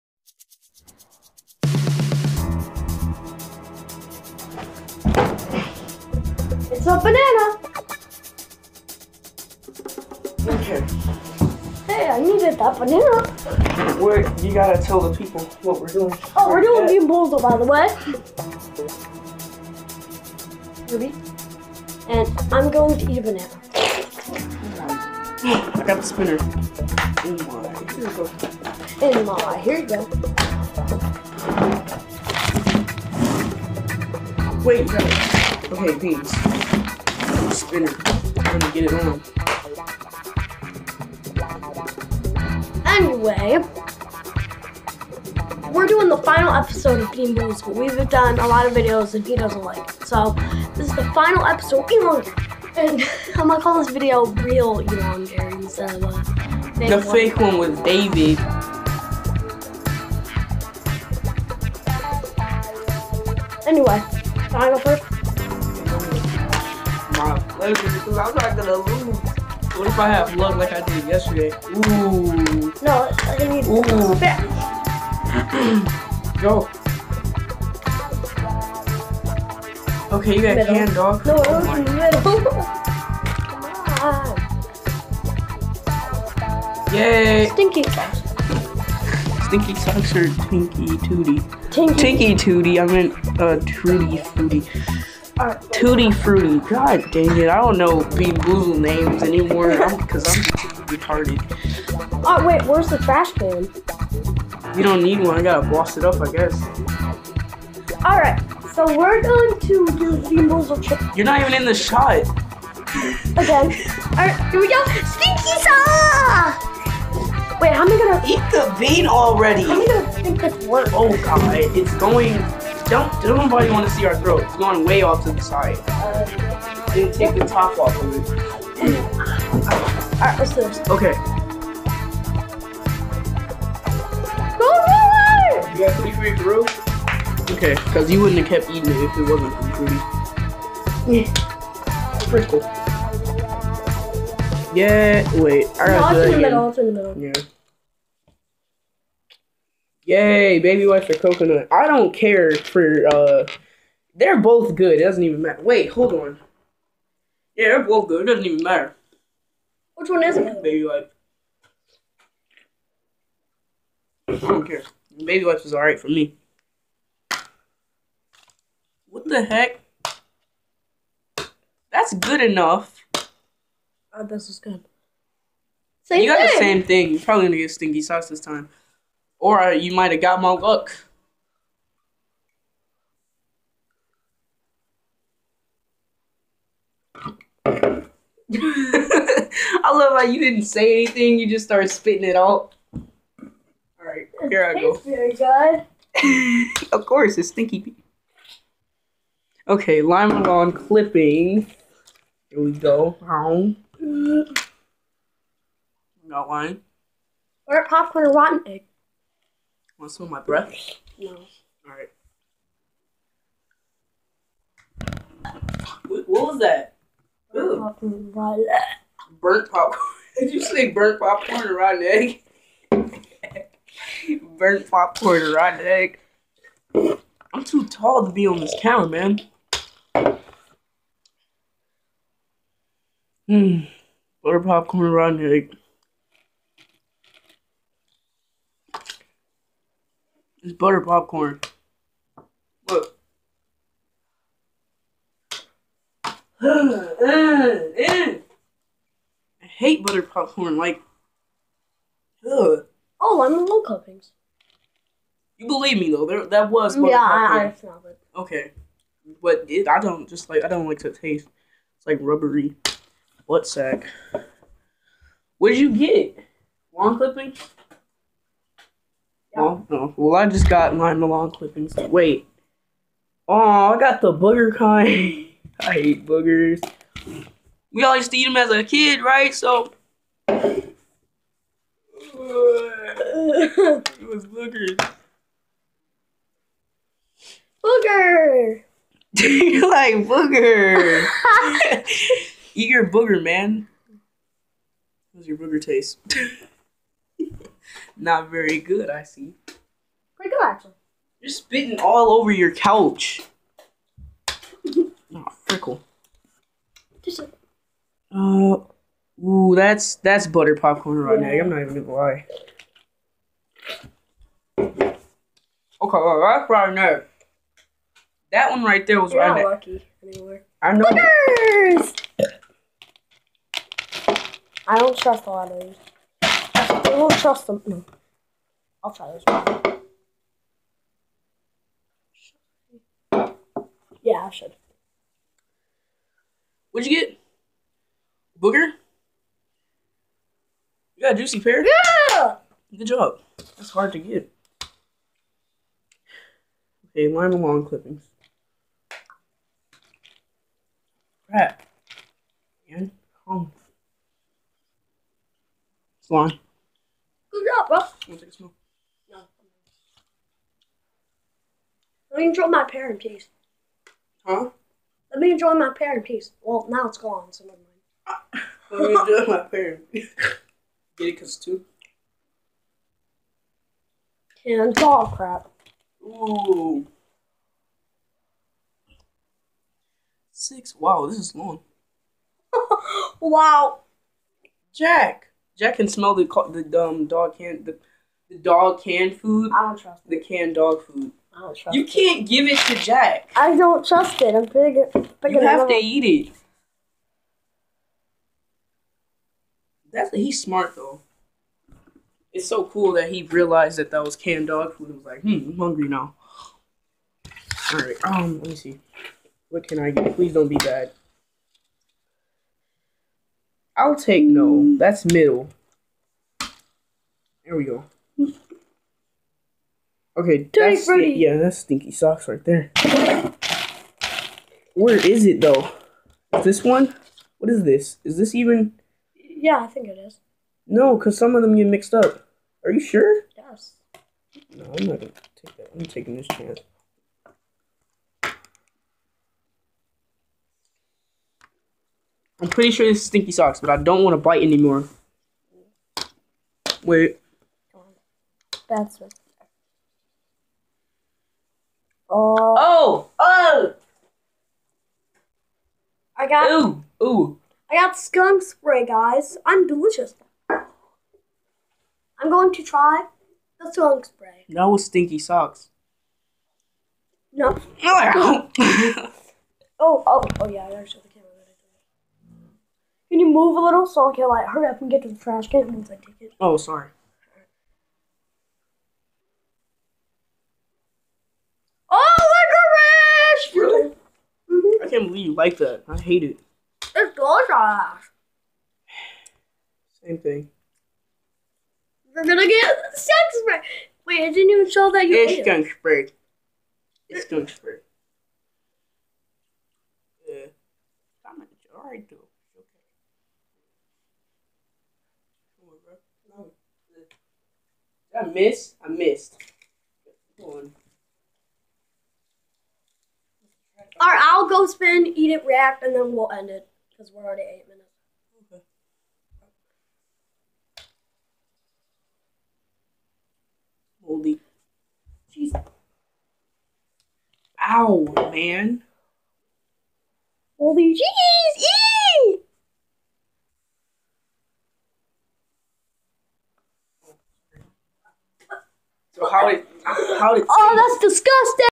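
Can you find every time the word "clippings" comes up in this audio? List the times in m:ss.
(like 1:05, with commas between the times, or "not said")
3:20, 4:27, 4:31, 5:47.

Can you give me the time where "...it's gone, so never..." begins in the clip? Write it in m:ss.
6:07.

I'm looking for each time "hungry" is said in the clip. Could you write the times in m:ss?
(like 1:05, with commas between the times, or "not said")
6:45.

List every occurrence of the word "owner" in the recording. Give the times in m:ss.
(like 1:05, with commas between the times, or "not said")
not said.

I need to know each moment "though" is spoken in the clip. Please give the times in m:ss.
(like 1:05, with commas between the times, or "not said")
4:16, 6:40, 7:05.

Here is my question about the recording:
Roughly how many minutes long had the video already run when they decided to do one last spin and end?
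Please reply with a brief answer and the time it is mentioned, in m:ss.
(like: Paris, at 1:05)
8, at 8:37.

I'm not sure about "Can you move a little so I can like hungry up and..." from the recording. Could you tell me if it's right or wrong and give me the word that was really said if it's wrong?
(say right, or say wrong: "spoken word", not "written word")
wrong: "hurry", not "hungry".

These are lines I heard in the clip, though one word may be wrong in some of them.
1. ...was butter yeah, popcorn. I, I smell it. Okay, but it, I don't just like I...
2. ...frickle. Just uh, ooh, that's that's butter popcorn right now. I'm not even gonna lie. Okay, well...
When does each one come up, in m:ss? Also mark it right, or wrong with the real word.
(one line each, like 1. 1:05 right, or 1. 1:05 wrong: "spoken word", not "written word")
1. 4:16 right
2. 5:05 right.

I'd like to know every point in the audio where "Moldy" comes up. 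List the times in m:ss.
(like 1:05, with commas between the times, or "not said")
8:44, 8:50.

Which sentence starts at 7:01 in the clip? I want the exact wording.
yeah, that's stinky socks right there.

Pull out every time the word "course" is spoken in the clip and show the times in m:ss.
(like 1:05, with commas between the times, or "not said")
3:17.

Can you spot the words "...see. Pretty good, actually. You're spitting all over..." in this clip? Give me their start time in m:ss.
4:59.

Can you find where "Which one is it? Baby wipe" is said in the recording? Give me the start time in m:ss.
2:39.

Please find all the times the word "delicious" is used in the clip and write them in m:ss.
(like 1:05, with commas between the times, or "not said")
7:39, 8:07.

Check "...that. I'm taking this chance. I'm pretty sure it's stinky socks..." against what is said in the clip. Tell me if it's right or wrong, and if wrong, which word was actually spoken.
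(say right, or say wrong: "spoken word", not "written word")
right.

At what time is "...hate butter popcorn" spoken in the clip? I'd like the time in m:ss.
4:09.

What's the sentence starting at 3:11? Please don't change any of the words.
You just started spitting it out.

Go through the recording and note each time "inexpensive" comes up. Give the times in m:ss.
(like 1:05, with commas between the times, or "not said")
not said.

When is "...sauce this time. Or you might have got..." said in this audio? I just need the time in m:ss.
2:58.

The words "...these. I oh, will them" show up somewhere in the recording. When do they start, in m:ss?
5:25.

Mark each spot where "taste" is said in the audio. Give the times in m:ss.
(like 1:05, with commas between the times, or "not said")
4:21, 4:55.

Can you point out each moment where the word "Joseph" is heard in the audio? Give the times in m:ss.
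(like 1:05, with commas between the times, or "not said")
not said.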